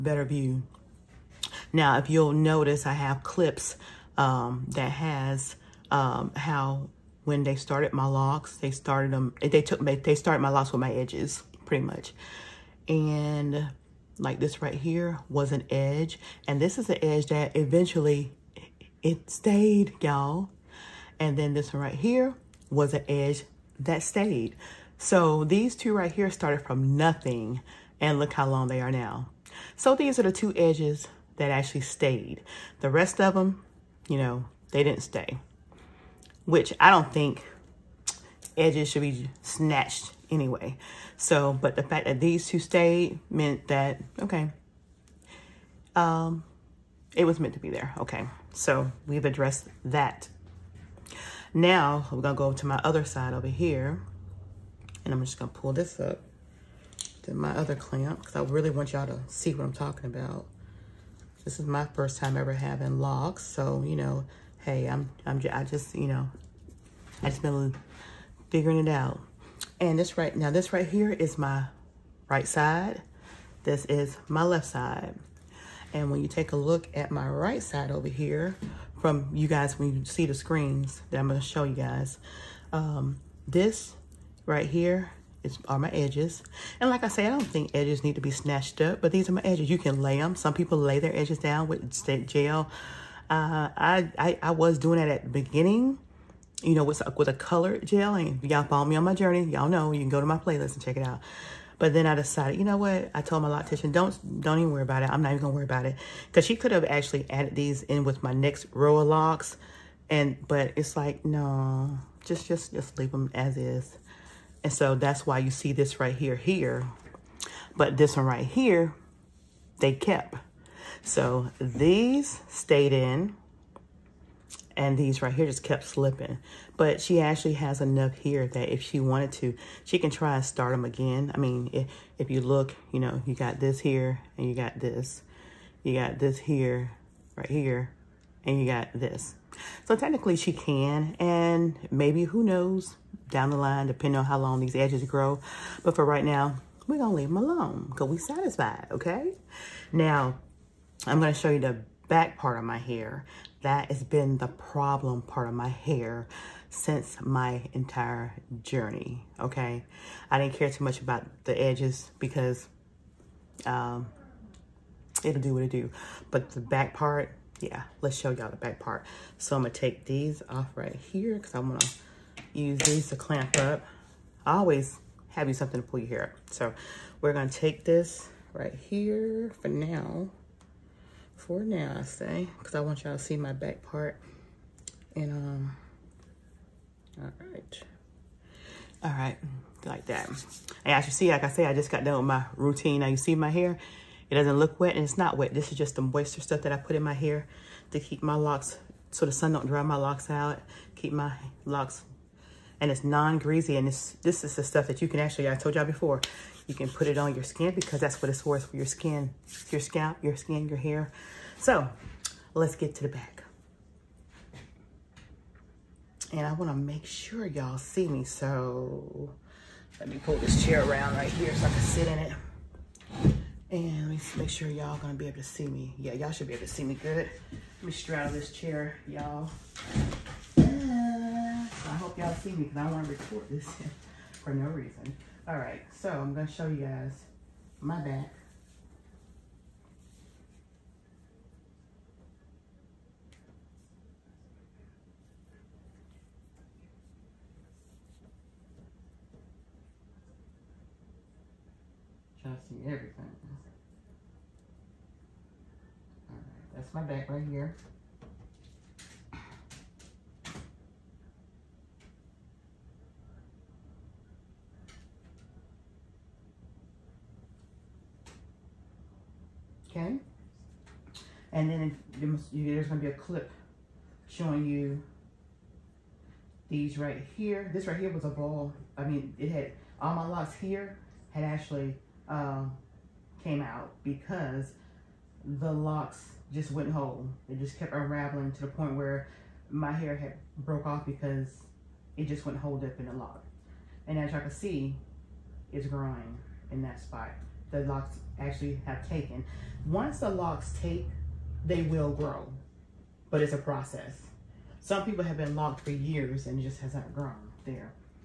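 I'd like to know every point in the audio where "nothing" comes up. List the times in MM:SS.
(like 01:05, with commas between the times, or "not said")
00:26.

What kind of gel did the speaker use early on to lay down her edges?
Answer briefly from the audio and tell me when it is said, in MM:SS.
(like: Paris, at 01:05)
colored gel, at 01:37.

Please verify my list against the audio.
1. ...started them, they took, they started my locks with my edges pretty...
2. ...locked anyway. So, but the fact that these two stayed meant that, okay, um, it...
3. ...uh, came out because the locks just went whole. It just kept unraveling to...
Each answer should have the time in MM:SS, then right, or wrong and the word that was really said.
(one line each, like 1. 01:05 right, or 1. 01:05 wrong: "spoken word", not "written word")
1. 00:08 right
2. 00:39 wrong: "snatched", not "locked"
3. 04:42 right.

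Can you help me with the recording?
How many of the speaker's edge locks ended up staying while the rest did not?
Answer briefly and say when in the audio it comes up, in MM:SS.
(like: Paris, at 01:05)
2, at 00:30.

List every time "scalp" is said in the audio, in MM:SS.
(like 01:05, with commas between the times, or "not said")
03:29.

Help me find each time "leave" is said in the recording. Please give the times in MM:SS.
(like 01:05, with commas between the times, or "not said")
01:52, 02:27.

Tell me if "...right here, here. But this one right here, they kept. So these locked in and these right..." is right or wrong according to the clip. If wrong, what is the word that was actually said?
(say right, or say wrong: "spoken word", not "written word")
wrong: "stayed", not "locked".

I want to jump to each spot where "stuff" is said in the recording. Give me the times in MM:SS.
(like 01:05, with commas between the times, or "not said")
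03:16, 03:24.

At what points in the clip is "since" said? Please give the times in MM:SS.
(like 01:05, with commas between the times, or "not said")
02:36.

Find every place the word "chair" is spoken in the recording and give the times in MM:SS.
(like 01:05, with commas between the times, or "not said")
03:40, 03:48.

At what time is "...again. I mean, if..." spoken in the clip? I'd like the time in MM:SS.
02:10.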